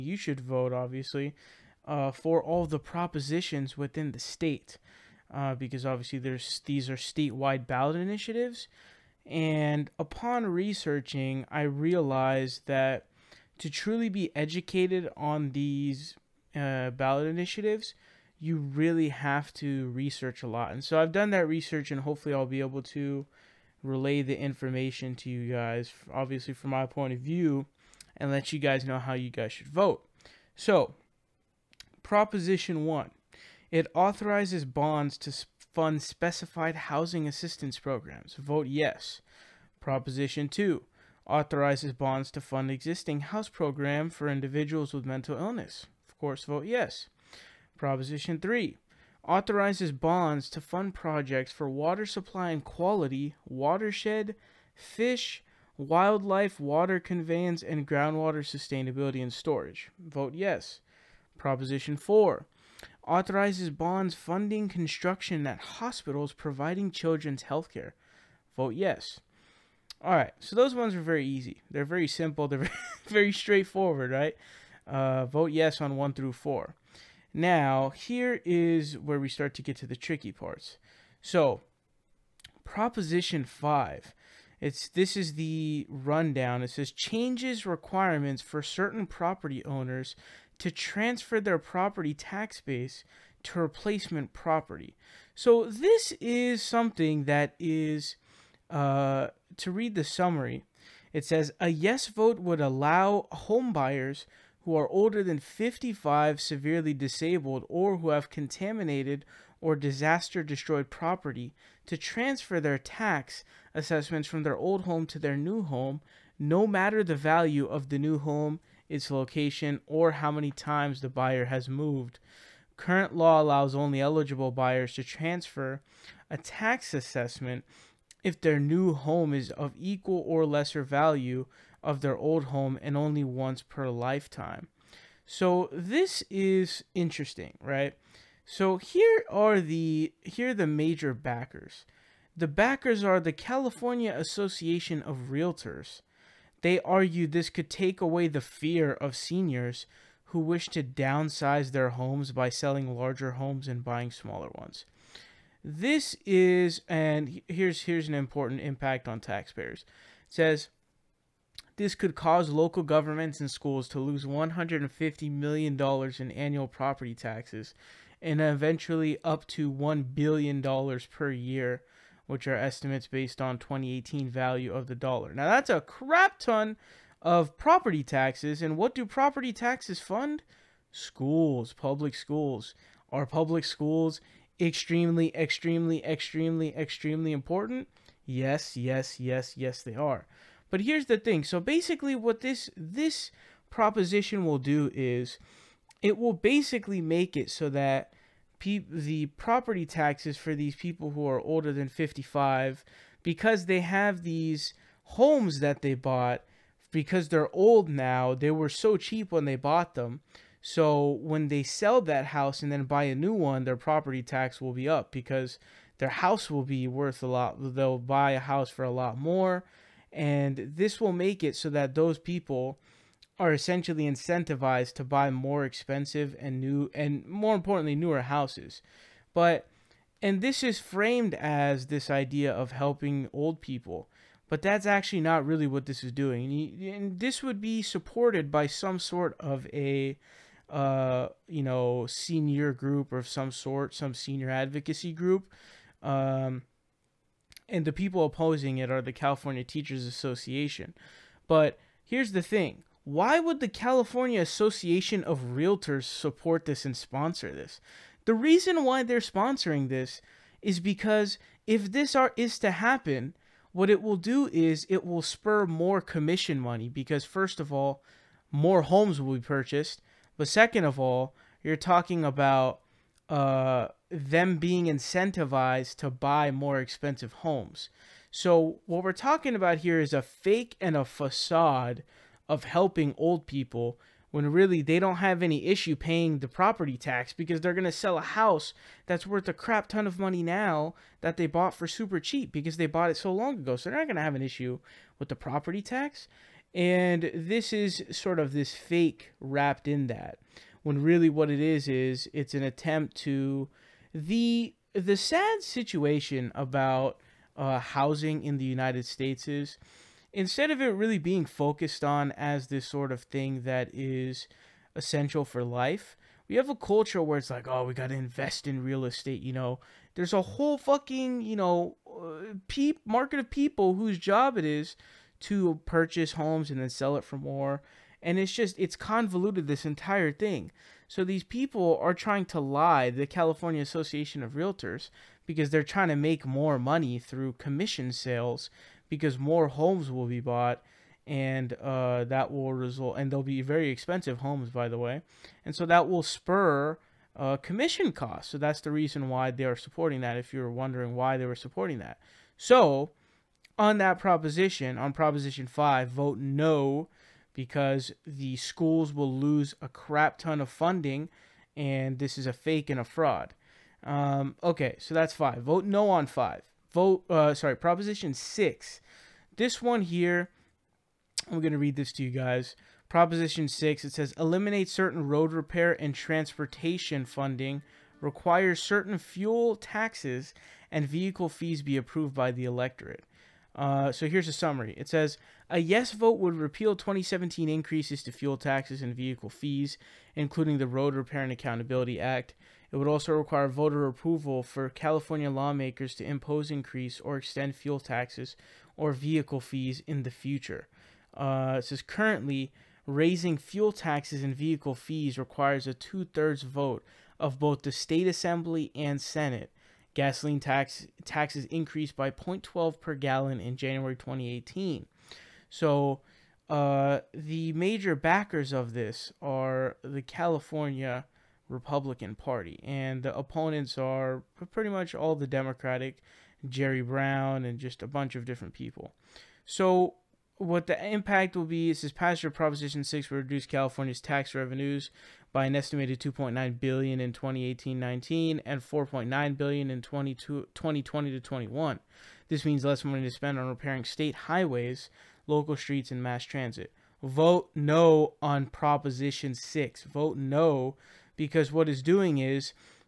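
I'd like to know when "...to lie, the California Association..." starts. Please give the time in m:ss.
5:32.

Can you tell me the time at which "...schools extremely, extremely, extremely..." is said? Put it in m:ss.
3:03.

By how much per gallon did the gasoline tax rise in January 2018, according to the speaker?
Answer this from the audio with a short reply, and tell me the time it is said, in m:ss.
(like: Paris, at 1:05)
0.12, at 6:52.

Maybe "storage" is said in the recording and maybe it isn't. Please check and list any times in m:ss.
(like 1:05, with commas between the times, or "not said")
0:59.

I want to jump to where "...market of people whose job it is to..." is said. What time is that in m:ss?
5:23.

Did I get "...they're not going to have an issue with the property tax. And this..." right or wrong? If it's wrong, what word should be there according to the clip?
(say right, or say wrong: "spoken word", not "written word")
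right.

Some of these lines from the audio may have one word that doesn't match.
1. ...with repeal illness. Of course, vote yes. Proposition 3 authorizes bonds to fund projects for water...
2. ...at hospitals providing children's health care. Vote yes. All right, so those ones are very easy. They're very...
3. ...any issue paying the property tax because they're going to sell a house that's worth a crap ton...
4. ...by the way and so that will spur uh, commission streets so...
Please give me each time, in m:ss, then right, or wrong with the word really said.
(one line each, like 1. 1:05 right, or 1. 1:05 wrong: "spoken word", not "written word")
1. 0:44 wrong: "mental", not "repeal"
2. 1:05 right
3. 4:45 right
4. 5:44 wrong: "costs", not "streets".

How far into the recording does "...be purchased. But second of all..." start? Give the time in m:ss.
4:29.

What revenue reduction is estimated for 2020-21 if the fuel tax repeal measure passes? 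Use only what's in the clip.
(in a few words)
$4.9 billion.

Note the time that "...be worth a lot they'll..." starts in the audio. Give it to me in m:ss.
3:36.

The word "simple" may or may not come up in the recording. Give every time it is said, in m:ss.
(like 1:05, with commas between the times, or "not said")
1:12.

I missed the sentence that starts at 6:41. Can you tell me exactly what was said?
Uh, it says currently, raising fuel taxes and vehicle fees requires a two thirds vote of both the state assembly and senate.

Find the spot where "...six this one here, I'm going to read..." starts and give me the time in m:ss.
6:08.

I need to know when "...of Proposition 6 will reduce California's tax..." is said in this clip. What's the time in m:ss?
7:12.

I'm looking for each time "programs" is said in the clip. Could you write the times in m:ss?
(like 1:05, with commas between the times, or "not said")
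0:37, 0:43.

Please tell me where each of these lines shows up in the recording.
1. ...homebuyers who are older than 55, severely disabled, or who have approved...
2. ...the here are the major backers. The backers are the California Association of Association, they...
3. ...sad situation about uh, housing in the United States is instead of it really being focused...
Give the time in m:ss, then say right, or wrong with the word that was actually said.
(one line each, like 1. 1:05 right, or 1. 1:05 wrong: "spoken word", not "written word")
1. 1:43 wrong: "contaminated", not "approved"
2. 2:19 wrong: "Realtors", not "Association"
3. 5:05 right.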